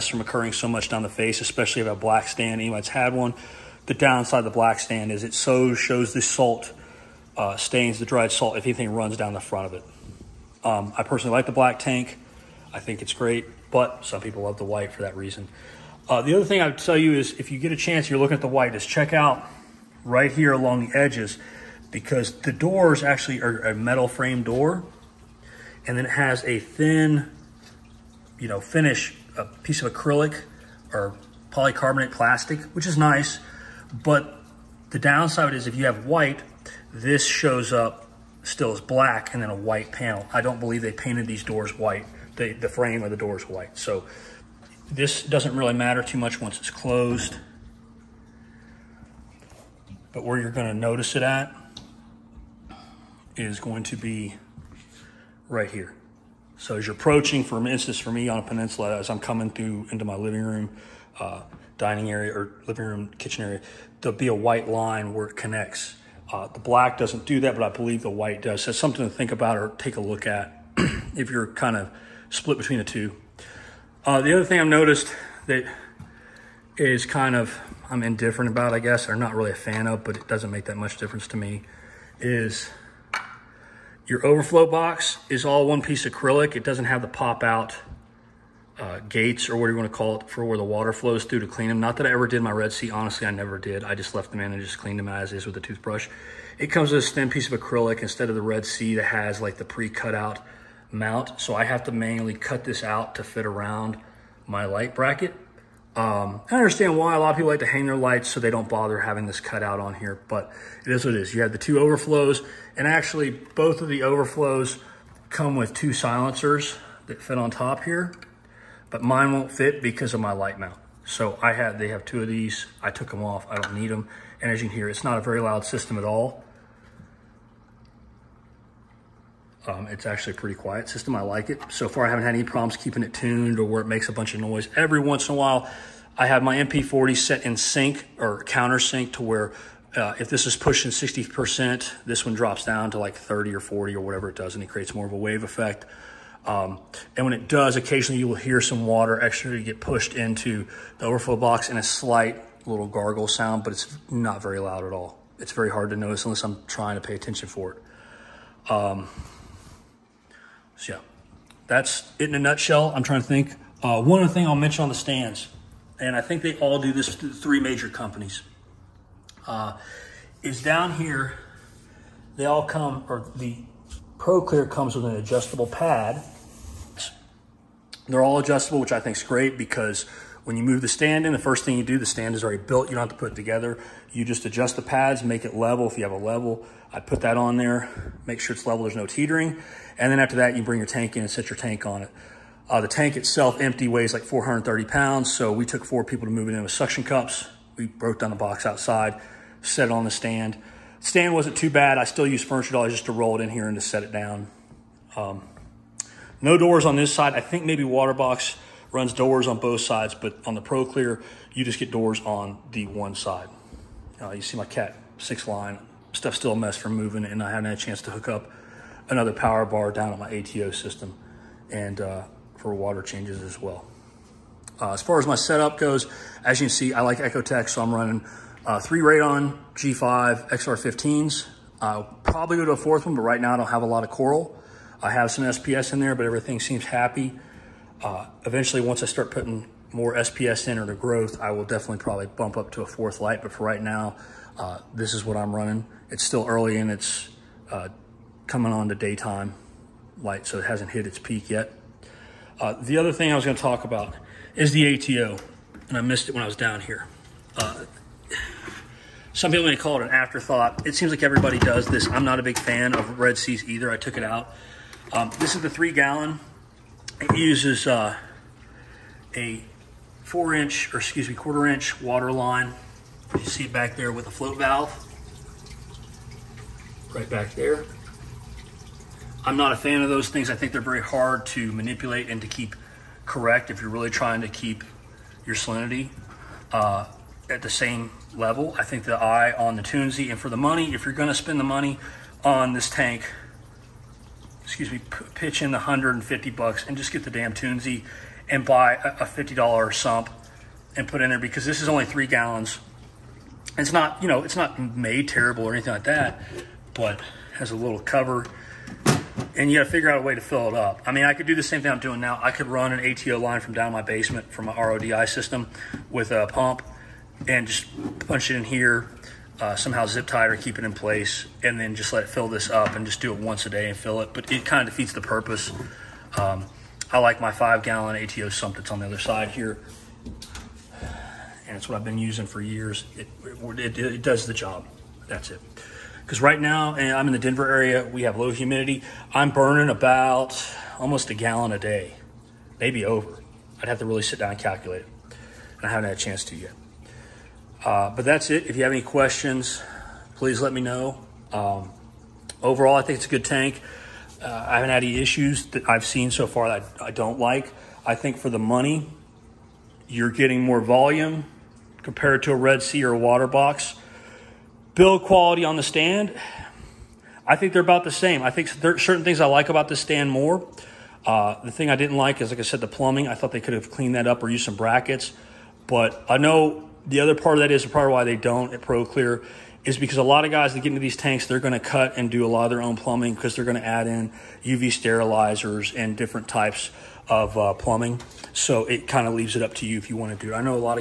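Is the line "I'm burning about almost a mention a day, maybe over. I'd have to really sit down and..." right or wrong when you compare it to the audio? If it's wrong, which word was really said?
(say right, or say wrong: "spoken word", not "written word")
wrong: "gallon", not "mention".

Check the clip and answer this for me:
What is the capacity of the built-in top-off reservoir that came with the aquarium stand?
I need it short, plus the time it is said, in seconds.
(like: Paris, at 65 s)
3 gallons, at 265 s.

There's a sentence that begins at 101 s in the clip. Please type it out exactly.
So I have to manually cut this out to fit around my light bracket.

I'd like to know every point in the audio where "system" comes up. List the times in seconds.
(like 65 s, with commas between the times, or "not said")
125 s, 130 s, 220 s, 315 s.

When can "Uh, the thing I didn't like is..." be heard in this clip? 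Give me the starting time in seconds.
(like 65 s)
371 s.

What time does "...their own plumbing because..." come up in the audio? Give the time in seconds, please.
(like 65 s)
382 s.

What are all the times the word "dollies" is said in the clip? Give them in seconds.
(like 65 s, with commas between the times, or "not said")
202 s.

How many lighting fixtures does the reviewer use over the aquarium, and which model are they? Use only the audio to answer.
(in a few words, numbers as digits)
3 Radion G5 XR15s.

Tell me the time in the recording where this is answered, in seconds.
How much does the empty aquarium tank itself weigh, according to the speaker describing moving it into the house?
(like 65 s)
194 s.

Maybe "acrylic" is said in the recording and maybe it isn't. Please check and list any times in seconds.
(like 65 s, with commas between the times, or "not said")
29 s, 86 s, 97 s.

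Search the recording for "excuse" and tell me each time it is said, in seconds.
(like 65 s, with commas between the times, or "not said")
270 s, 294 s.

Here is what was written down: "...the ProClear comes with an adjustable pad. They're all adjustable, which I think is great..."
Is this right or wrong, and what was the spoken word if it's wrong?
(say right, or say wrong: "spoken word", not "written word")
right.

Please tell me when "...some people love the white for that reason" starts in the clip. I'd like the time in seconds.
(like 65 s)
14 s.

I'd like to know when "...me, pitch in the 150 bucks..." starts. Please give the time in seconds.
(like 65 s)
294 s.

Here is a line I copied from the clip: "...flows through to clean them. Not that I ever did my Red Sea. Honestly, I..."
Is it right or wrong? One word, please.
right.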